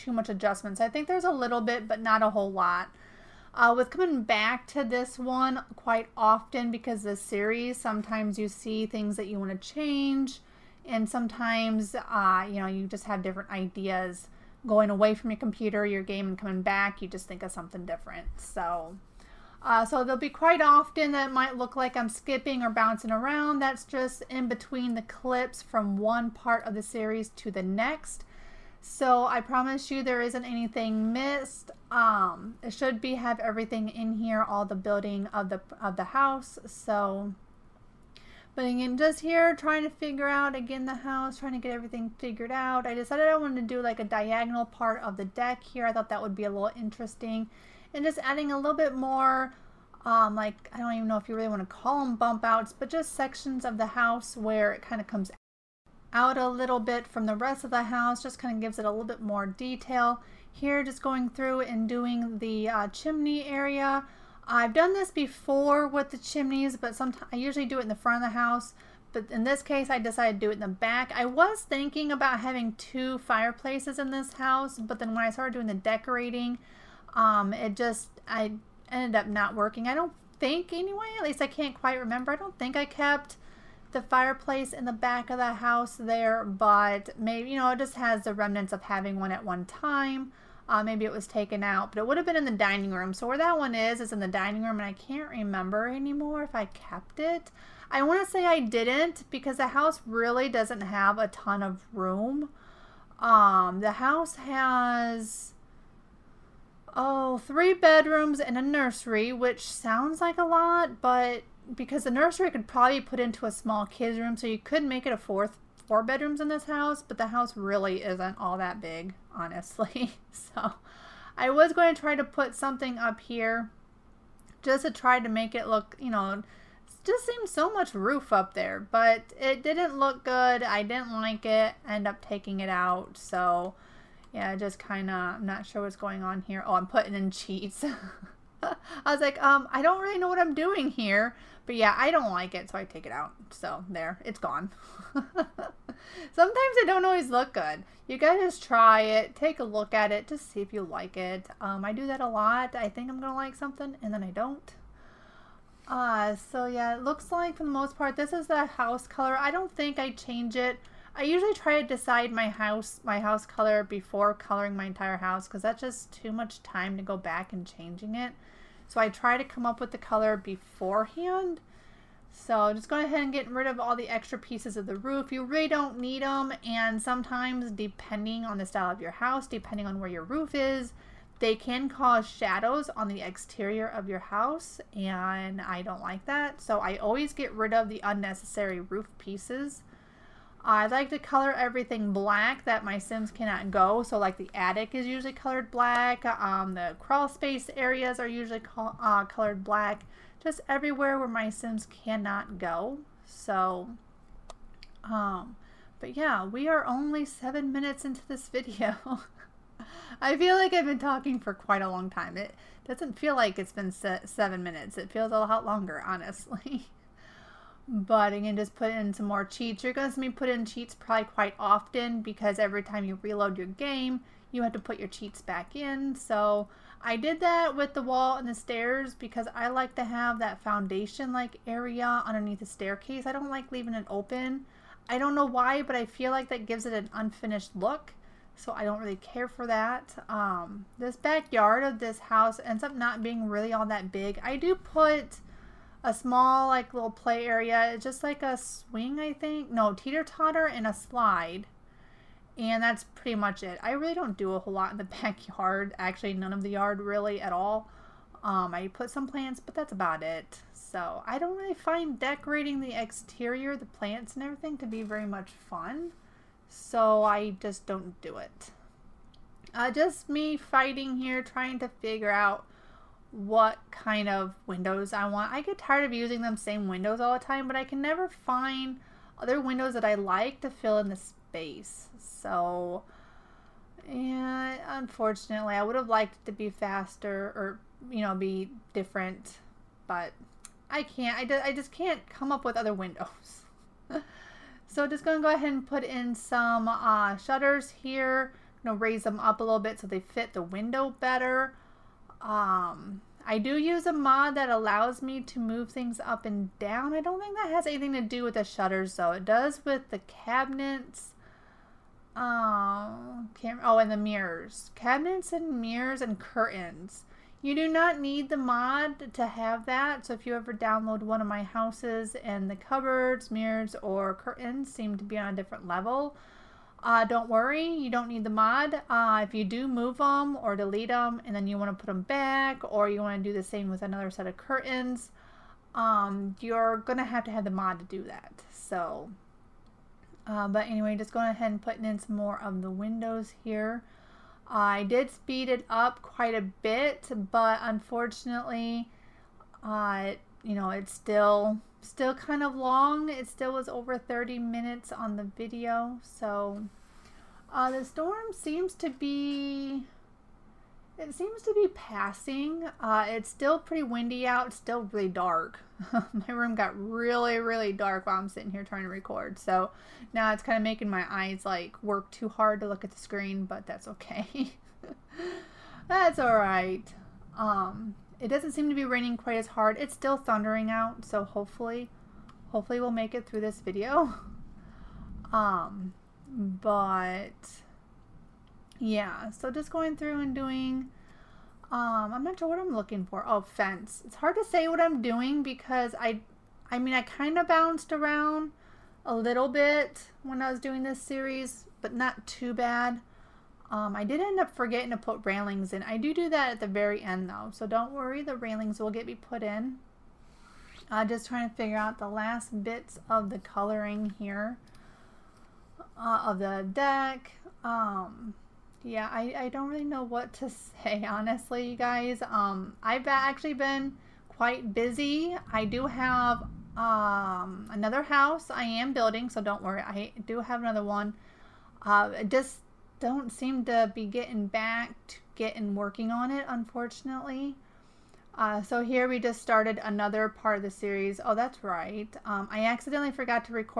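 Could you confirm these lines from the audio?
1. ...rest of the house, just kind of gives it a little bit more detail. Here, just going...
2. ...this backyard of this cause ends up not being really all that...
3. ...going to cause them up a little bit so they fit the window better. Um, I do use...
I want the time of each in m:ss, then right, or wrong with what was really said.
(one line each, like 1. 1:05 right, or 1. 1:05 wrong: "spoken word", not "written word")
1. 0:57 right
2. 4:00 wrong: "house", not "cause"
3. 4:58 wrong: "raise", not "cause".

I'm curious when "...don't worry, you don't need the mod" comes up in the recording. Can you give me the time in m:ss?
5:27.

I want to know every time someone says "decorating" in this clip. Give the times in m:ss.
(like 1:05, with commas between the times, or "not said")
1:15, 4:22.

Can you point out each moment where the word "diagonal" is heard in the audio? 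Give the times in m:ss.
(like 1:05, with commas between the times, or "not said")
0:44.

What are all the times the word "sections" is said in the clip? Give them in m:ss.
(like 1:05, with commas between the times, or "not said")
0:53.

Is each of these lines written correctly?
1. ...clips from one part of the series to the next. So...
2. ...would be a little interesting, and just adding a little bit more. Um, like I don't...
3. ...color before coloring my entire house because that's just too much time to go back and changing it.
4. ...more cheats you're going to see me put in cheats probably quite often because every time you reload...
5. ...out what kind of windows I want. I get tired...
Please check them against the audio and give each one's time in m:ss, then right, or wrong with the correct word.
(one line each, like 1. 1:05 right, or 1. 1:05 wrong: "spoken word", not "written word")
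1. 0:25 right
2. 0:46 right
3. 2:43 right
4. 3:39 right
5. 4:32 right.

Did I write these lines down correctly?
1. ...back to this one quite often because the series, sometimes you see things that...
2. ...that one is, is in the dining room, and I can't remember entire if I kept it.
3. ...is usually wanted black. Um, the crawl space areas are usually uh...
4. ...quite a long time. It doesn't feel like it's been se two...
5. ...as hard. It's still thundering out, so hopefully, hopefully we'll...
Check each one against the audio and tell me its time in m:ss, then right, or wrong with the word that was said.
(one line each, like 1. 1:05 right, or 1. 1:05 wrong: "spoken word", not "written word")
1. 0:04 right
2. 1:33 wrong: "anymore", not "entire"
3. 3:14 wrong: "colored", not "wanted"
4. 3:31 wrong: "seven", not "two"
5. 6:19 right.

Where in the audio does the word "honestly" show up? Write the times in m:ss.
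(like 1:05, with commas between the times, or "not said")
1:59, 3:36, 7:01.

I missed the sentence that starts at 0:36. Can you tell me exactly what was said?
So, but again, just here trying to figure out again the house, trying to get everything figured out.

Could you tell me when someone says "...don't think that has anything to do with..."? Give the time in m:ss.
5:07.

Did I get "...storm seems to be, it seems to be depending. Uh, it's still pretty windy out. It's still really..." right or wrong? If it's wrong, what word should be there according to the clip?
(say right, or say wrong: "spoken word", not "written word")
wrong: "passing", not "depending".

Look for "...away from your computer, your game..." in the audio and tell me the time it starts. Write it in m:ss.
0:14.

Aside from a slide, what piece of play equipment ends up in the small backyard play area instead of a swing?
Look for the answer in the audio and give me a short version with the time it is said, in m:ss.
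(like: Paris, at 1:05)
teeter totter, at 4:09.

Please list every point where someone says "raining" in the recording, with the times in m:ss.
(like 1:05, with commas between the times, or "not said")
6:19.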